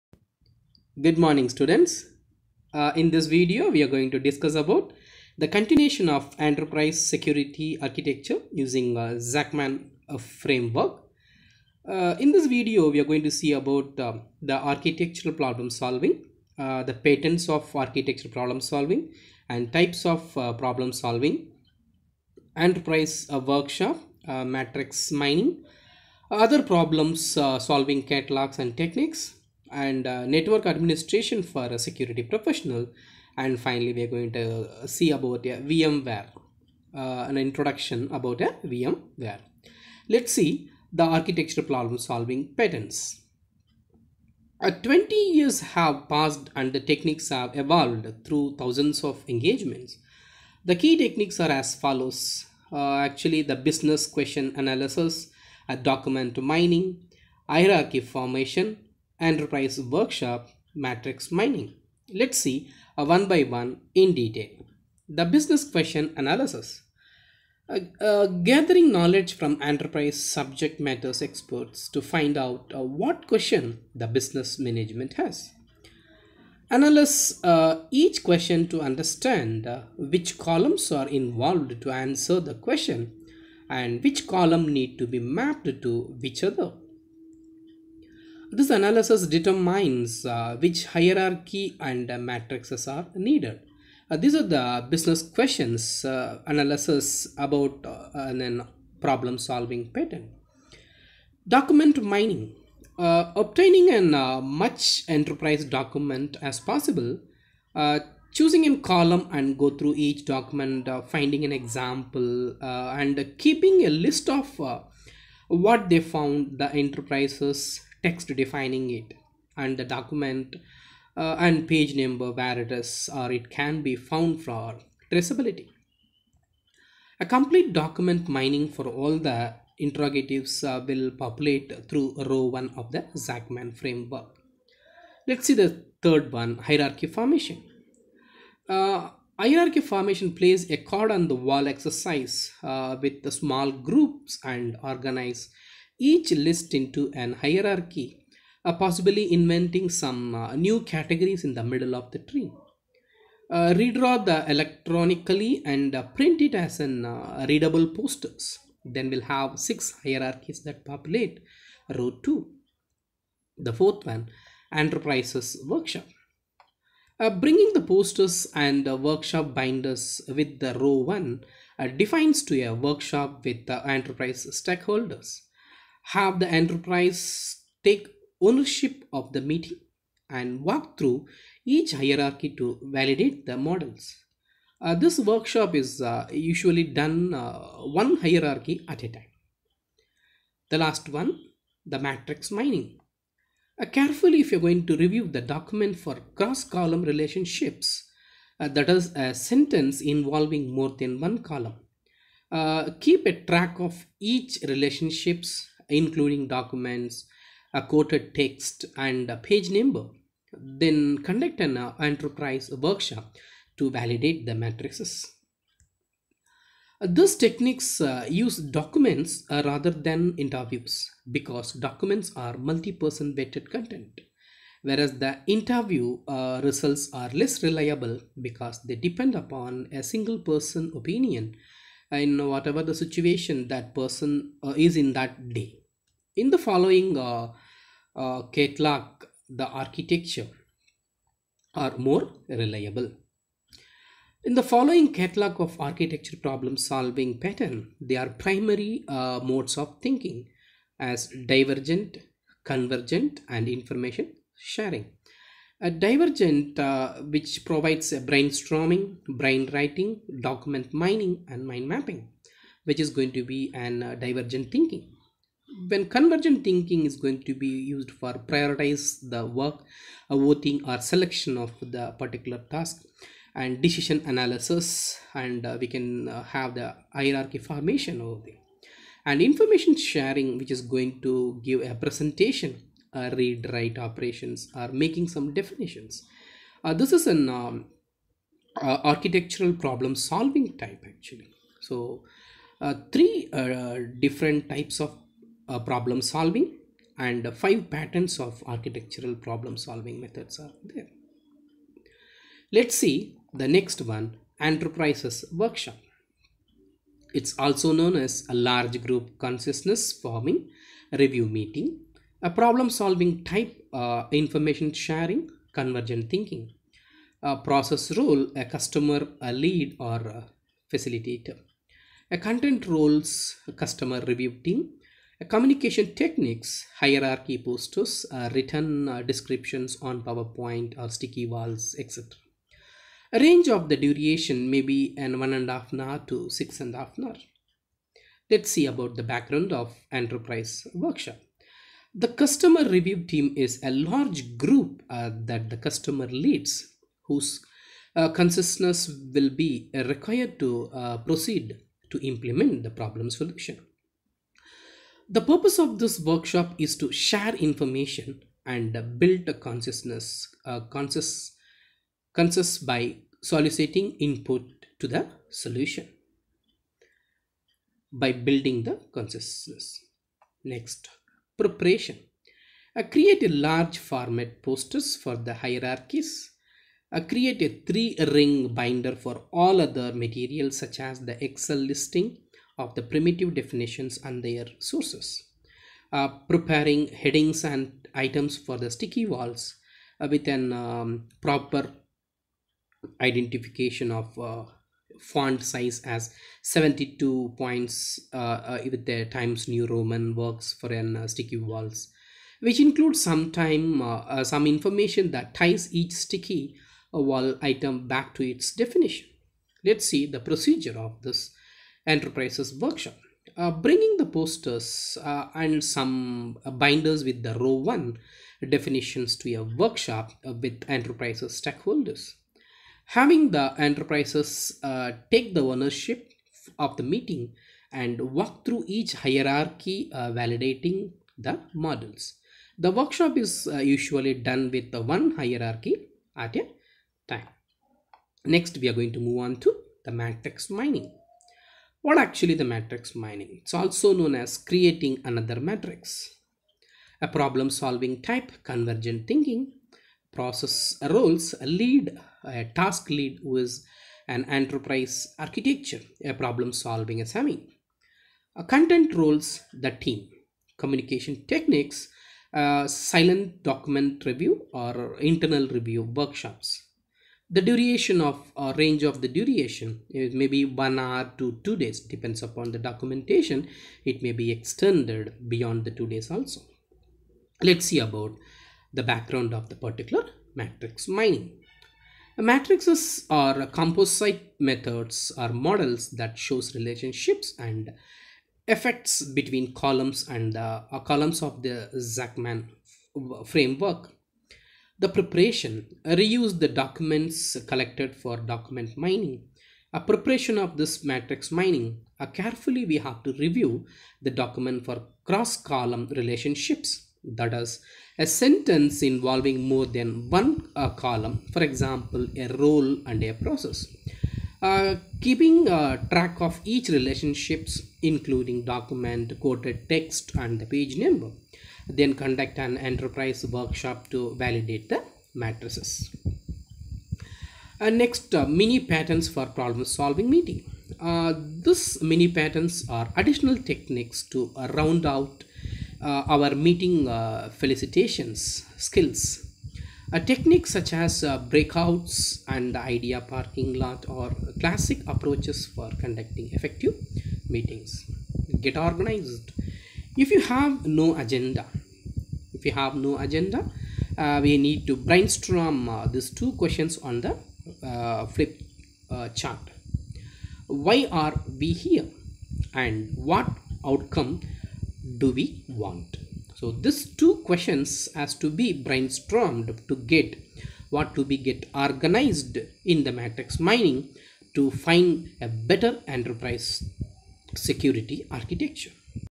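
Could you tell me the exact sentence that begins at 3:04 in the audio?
Uh, this workshop is uh, usually done uh, one hierarchy at a time.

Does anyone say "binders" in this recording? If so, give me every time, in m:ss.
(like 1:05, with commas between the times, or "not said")
2:49, 6:18, 6:56.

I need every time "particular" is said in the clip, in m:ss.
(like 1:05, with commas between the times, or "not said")
4:32, 7:59.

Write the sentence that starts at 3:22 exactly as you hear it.
Uh, keep a track of each relationships including documents, a quoted text and a page number.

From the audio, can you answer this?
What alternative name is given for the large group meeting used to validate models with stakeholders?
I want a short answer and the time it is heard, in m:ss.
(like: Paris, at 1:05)
Consciousness forming review meeting, at 5:08.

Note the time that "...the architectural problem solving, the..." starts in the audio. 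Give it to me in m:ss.
0:14.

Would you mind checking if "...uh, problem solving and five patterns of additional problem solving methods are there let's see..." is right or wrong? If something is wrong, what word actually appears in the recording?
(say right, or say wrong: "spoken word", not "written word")
wrong: "architectural", not "additional".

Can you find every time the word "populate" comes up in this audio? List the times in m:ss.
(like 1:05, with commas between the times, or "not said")
2:11, 2:40.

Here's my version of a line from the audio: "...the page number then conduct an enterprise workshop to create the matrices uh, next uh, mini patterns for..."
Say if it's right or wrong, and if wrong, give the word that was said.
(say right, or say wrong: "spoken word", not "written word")
wrong: "validate", not "create".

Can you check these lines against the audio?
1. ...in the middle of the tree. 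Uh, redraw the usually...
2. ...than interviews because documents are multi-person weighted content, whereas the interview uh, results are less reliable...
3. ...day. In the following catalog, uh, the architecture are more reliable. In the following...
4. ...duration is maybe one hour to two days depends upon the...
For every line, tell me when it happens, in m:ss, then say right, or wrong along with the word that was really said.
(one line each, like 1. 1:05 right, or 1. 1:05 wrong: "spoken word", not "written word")
1. 2:31 wrong: "electronically", not "usually"
2. 3:39 right
3. 3:55 right
4. 7:49 right.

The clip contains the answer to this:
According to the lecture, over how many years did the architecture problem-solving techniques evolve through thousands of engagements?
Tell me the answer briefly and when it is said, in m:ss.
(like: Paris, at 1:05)
20, at 0:44.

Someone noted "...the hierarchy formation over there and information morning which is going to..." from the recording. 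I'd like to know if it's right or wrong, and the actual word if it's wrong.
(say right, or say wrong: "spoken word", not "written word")
wrong: "sharing", not "morning".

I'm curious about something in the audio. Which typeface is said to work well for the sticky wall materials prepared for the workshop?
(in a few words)
Times New Roman.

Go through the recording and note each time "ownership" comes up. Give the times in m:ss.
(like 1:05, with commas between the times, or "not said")
2:58, 7:05.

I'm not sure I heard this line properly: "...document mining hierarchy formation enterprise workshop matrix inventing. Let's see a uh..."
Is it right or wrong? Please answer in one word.
wrong.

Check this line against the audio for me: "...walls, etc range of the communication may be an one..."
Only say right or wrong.
wrong.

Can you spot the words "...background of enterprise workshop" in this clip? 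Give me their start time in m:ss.
5:39.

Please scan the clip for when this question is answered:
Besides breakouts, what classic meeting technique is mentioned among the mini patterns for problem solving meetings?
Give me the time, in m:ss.
9:02.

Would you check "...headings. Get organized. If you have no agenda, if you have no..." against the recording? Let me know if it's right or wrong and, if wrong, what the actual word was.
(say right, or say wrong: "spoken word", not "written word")
wrong: "meetings", not "headings".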